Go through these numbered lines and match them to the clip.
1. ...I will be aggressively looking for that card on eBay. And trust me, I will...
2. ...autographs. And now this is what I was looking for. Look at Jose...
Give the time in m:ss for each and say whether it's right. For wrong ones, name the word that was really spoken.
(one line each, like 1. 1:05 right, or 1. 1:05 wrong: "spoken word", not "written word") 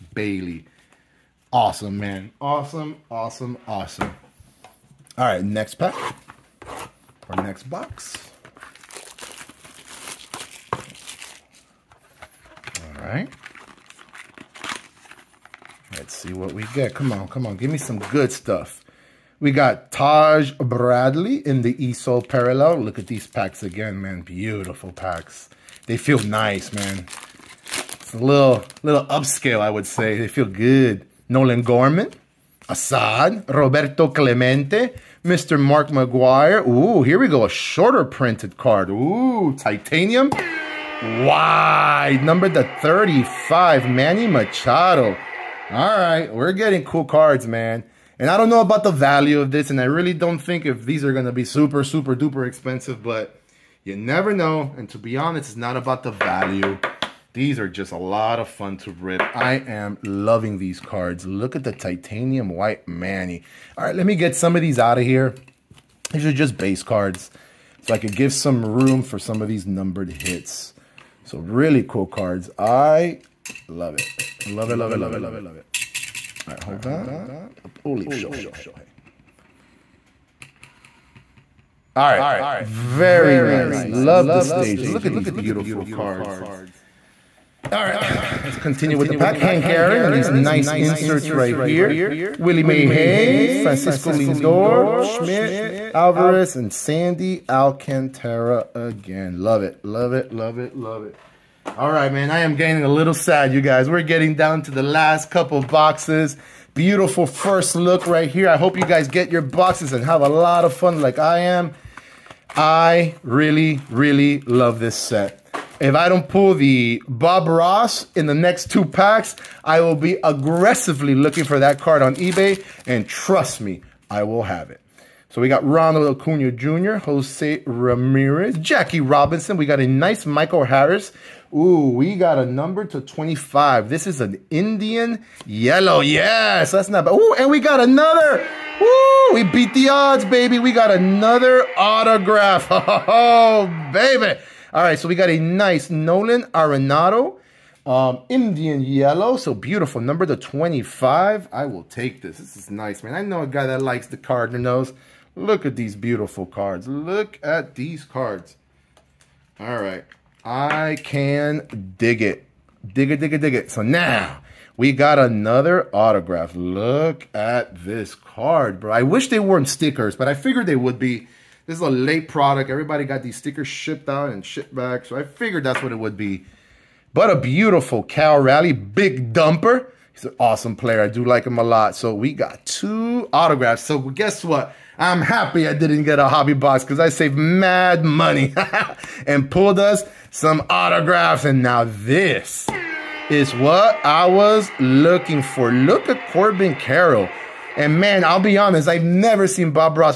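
1. 1:59 right
2. 3:10 wrong: "Corbin", not "Jose".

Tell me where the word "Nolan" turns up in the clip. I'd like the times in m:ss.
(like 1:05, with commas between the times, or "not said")
0:31, 2:25.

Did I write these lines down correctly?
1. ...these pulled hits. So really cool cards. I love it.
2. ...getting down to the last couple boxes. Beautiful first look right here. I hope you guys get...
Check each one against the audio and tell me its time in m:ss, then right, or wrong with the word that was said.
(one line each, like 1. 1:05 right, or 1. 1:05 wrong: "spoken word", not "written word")
1. 1:09 wrong: "numbered", not "pulled"
2. 1:44 right.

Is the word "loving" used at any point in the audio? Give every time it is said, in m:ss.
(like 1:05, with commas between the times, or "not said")
1:00.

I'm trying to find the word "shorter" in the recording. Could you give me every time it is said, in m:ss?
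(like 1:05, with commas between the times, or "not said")
0:37.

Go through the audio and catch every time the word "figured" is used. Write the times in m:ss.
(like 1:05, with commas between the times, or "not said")
2:50, 2:55.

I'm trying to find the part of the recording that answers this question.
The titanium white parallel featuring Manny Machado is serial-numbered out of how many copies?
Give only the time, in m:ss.
0:42.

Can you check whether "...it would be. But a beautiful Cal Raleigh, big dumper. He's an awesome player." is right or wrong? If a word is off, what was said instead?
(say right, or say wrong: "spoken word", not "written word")
right.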